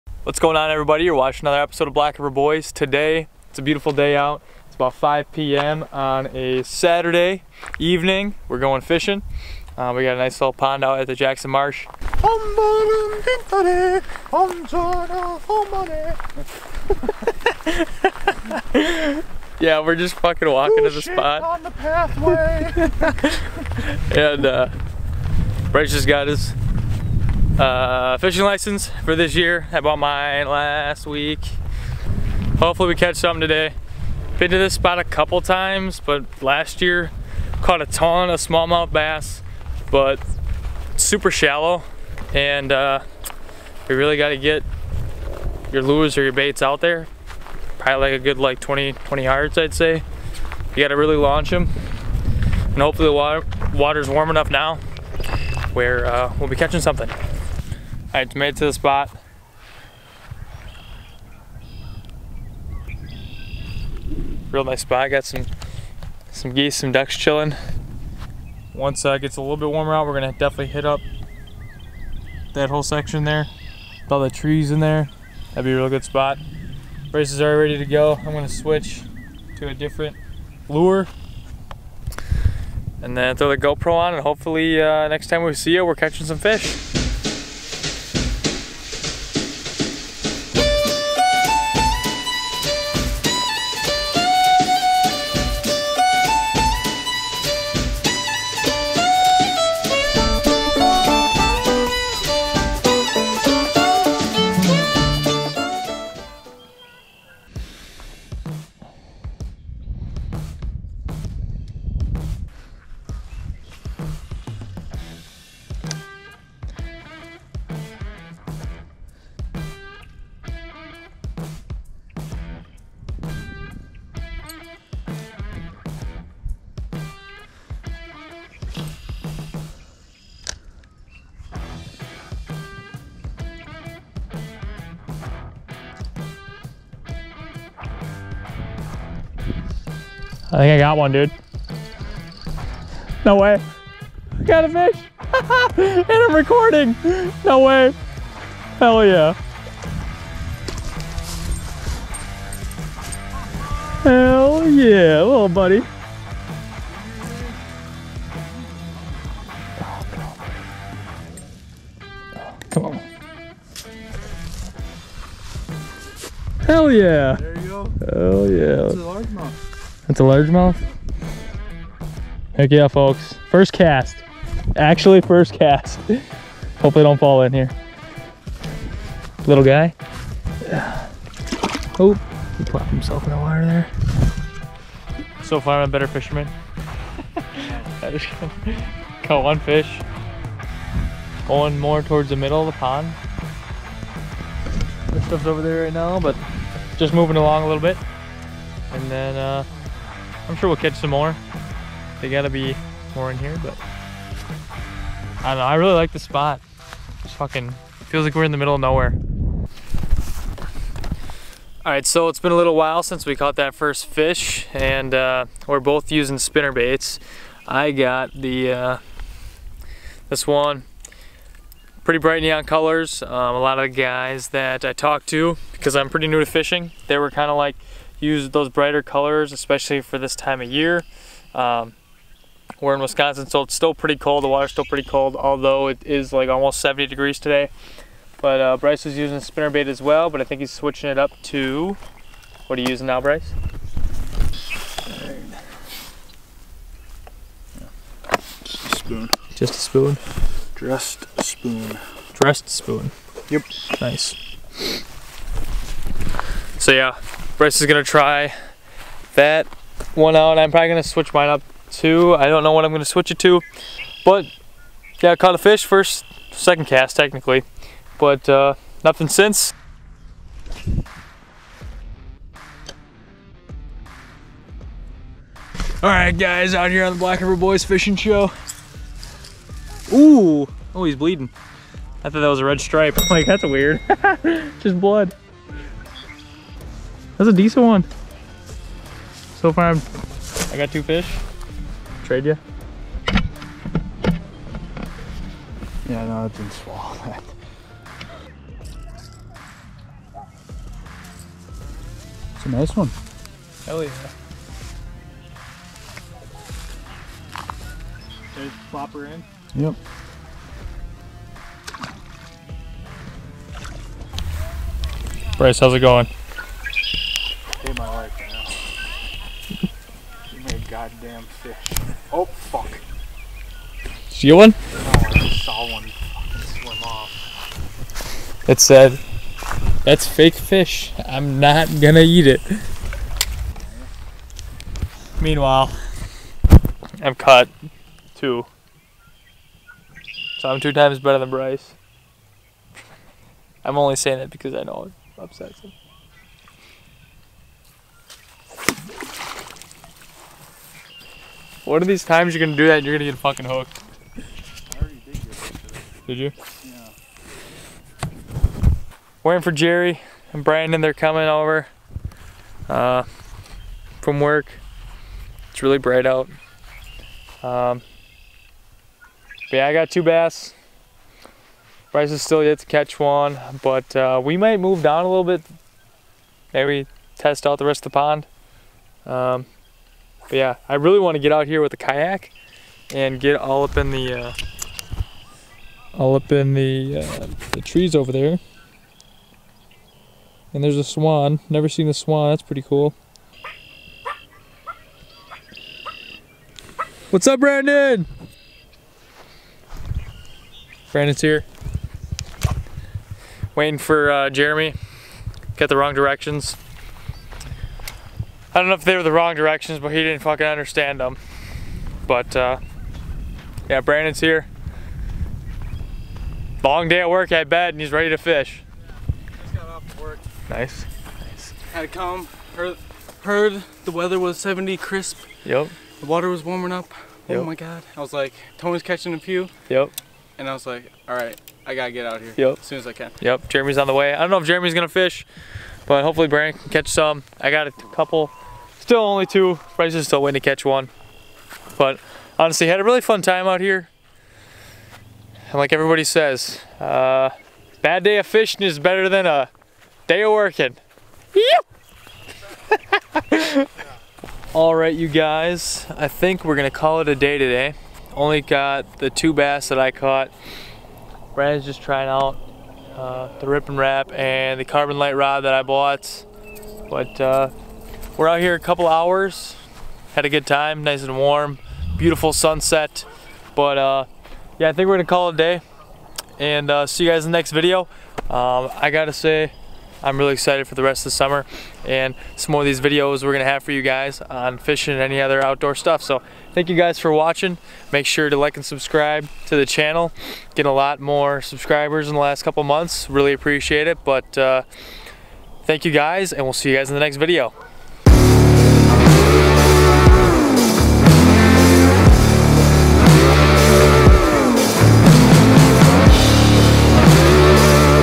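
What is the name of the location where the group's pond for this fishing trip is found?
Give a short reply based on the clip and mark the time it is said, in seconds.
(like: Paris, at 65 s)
Jackson Marsh, at 11 s.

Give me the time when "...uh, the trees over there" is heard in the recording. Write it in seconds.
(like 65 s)
387 s.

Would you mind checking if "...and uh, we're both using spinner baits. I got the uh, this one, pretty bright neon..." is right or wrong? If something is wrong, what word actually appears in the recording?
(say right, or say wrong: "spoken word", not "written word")
right.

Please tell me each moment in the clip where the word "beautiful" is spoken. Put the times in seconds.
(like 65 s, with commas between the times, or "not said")
3 s, 472 s.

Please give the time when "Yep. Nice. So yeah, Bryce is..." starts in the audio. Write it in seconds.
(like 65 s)
253 s.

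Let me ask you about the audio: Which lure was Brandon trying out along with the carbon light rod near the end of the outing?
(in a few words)
Rippin' Rap.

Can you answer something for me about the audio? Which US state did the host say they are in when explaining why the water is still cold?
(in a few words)
Wisconsin.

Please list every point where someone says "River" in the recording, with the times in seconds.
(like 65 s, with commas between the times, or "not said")
2 s, 277 s.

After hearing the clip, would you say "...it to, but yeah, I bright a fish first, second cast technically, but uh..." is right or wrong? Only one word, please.
wrong.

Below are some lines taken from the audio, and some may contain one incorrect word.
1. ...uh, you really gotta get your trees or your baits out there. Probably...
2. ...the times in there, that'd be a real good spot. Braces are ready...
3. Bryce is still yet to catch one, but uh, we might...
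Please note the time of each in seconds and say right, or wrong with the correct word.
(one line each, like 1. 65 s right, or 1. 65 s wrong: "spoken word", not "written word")
1. 42 s wrong: "lures", not "trees"
2. 74 s wrong: "trees", not "times"
3. 372 s right.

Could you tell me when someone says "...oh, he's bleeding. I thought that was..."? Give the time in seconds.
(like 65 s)
280 s.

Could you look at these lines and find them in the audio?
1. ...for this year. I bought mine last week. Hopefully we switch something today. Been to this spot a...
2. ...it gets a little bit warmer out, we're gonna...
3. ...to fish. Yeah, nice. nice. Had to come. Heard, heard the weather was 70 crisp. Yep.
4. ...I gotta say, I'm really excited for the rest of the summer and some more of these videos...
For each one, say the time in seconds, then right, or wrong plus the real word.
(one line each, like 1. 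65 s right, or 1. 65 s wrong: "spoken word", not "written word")
1. 29 s wrong: "catch", not "switch"
2. 69 s right
3. 418 s right
4. 478 s right.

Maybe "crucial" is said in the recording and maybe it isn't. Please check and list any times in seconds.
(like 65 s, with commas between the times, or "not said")
not said.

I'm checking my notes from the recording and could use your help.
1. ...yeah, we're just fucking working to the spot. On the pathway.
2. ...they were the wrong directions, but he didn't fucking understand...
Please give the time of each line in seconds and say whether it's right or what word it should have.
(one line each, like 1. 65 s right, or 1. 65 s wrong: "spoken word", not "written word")
1. 19 s wrong: "walking", not "working"
2. 409 s right.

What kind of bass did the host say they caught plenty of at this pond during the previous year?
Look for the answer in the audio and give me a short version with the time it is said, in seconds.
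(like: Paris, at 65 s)
smallmouth bass, at 38 s.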